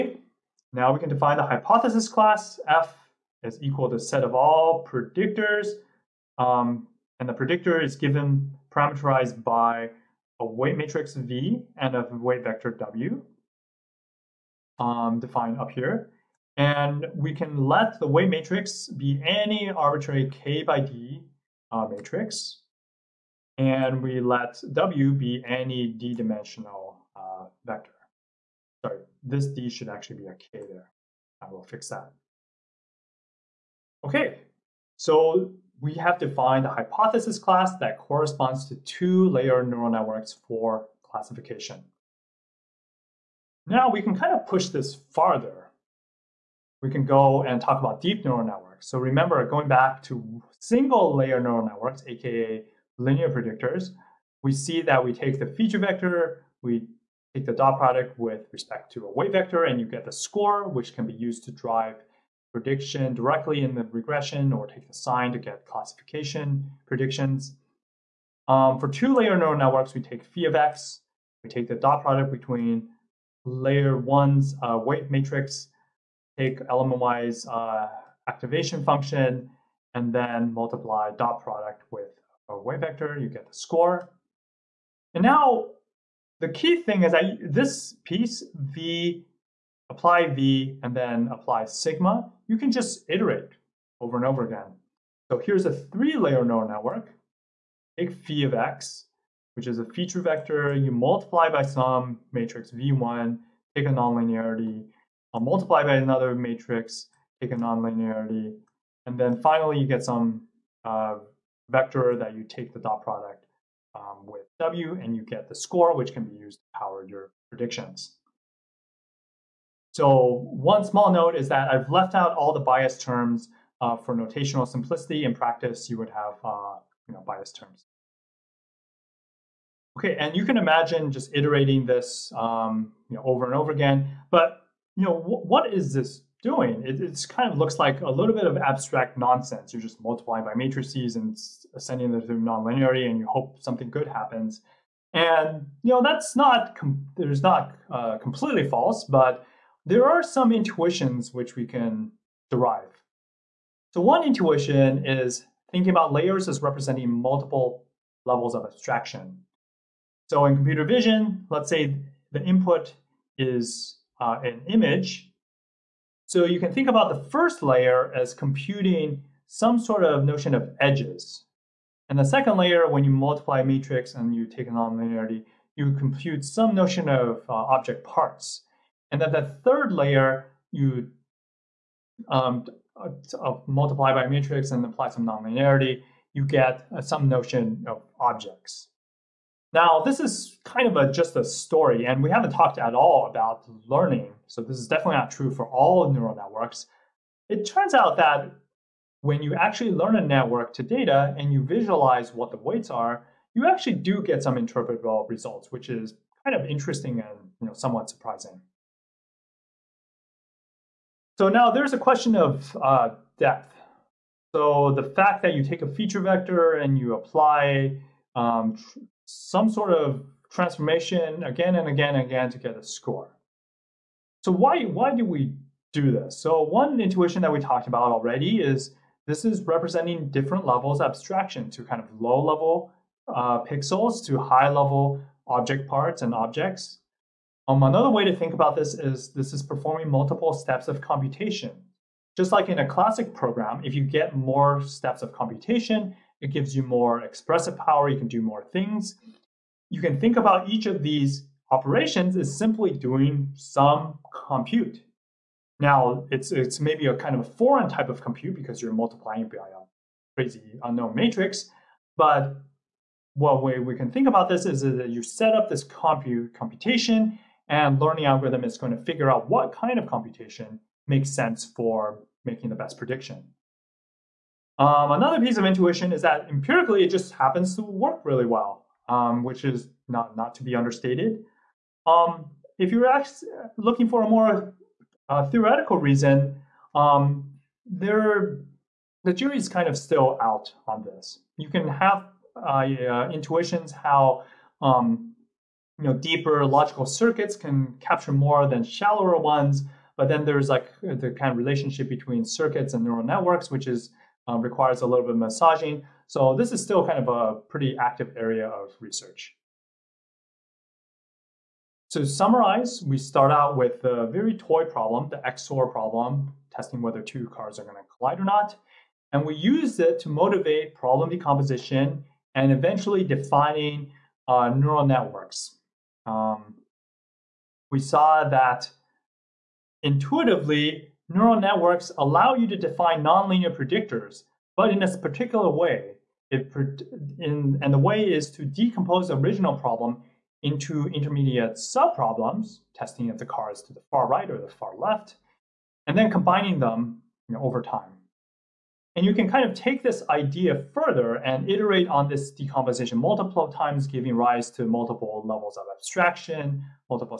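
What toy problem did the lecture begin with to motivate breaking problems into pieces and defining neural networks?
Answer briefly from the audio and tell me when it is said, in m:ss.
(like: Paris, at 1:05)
The XOR problem, at 5:15.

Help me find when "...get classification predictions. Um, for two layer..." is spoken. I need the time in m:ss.
1:05.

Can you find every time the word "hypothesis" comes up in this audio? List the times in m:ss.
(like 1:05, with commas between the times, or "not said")
0:01, 0:36.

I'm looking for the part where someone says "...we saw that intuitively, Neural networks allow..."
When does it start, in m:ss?
5:27.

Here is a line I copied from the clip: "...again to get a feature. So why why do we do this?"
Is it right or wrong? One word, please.
wrong.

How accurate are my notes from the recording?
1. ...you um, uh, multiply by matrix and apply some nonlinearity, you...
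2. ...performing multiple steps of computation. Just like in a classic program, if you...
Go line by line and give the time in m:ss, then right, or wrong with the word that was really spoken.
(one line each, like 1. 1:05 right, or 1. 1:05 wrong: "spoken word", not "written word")
1. 3:00 right
2. 3:59 right.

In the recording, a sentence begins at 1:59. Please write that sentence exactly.
So one small note is that I've left out all the bias terms uh, for notational simplicity.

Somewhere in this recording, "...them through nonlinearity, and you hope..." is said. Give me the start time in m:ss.
2:22.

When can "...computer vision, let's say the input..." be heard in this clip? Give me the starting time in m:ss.
2:40.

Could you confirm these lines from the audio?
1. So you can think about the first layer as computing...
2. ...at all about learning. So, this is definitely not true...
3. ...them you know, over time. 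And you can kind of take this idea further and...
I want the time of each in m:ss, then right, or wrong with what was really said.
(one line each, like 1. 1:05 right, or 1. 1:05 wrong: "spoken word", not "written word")
1. 2:46 right
2. 3:12 right
3. 5:46 right.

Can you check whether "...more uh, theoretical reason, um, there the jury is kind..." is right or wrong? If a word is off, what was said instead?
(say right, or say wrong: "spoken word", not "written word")
right.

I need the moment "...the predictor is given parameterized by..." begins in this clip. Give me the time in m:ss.
0:07.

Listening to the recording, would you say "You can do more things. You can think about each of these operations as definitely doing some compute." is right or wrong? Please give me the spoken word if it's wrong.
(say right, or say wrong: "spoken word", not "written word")
wrong: "simply", not "definitely".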